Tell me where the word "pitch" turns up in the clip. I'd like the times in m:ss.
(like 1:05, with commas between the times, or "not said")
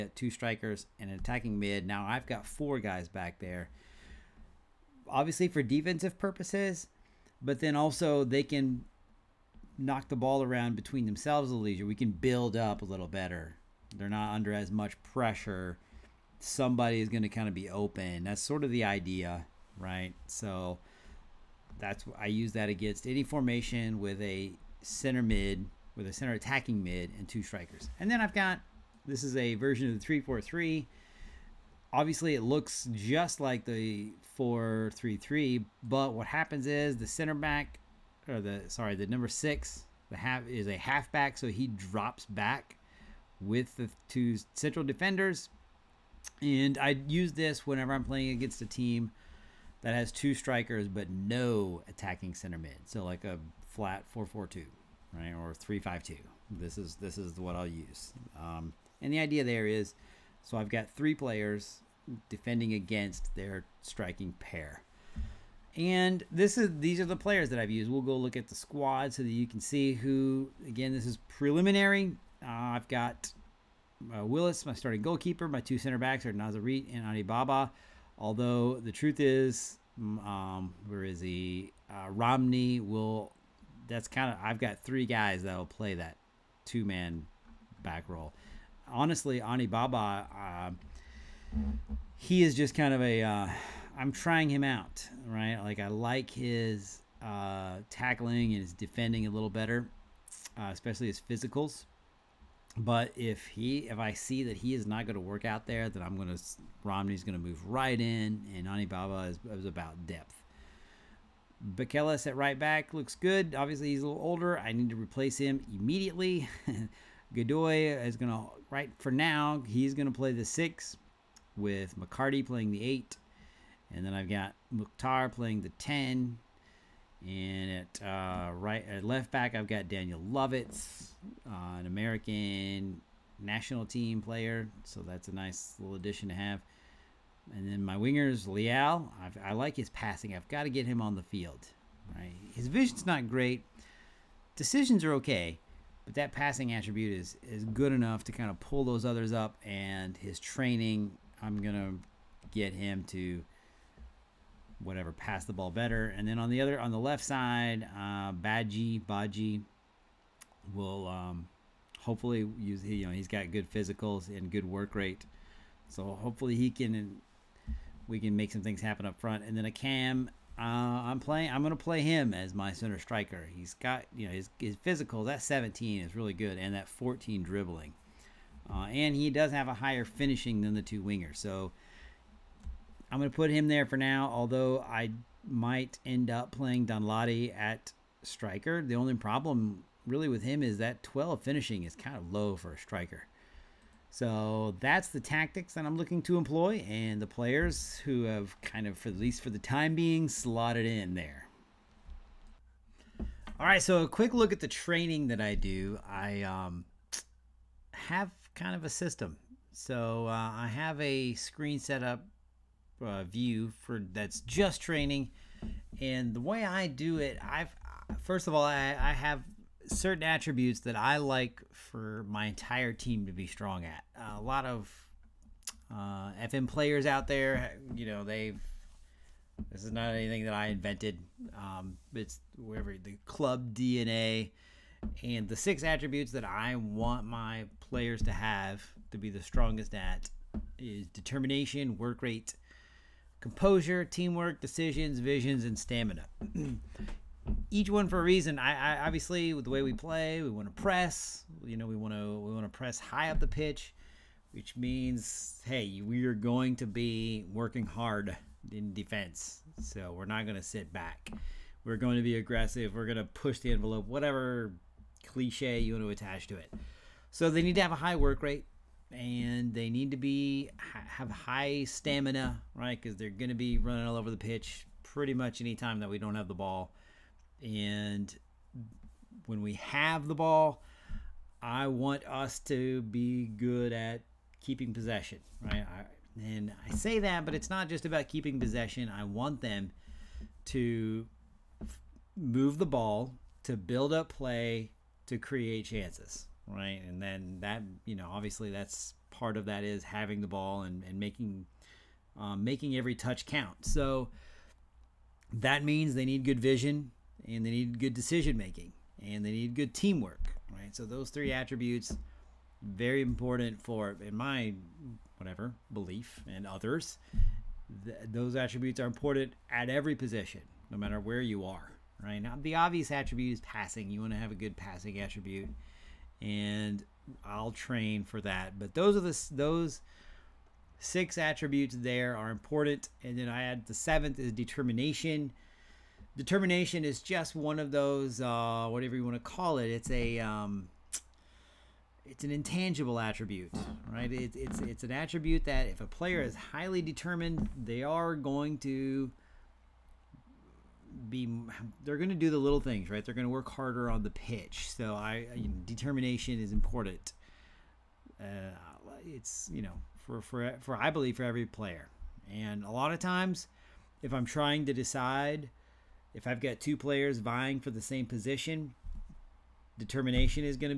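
4:13, 4:34, 5:54.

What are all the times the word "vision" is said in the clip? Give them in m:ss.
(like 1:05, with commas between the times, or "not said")
2:22, 4:05, 5:06.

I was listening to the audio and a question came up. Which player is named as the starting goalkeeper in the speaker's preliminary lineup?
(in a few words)
Willis.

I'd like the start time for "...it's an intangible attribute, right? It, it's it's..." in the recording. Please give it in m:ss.
5:42.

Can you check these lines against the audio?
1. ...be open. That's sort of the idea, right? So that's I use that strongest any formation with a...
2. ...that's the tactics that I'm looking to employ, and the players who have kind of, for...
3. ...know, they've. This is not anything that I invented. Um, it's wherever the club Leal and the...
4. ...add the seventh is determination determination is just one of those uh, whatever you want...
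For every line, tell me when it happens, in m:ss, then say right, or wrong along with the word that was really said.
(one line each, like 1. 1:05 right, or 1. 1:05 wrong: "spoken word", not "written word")
1. 0:17 wrong: "against", not "strongest"
2. 3:14 right
3. 3:48 wrong: "DNA", not "Leal"
4. 5:33 right.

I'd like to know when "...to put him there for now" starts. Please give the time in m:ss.
3:03.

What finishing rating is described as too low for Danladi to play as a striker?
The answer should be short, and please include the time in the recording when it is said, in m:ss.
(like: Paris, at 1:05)
12, at 3:11.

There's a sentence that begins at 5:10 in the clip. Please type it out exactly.
So those three attributes very important for in my whatever belief and others.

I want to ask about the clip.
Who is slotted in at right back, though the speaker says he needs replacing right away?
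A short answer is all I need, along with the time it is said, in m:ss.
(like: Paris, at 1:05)
Beckeles, at 1:51.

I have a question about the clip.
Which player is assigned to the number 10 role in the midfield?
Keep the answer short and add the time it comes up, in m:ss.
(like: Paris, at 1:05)
Mukhtar, at 2:04.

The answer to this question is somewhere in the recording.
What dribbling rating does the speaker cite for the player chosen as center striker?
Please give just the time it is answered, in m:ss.
2:56.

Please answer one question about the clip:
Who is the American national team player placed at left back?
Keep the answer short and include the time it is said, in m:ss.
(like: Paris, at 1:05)
Daniel Lovitz, at 2:09.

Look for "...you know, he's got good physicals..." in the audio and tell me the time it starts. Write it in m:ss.
2:42.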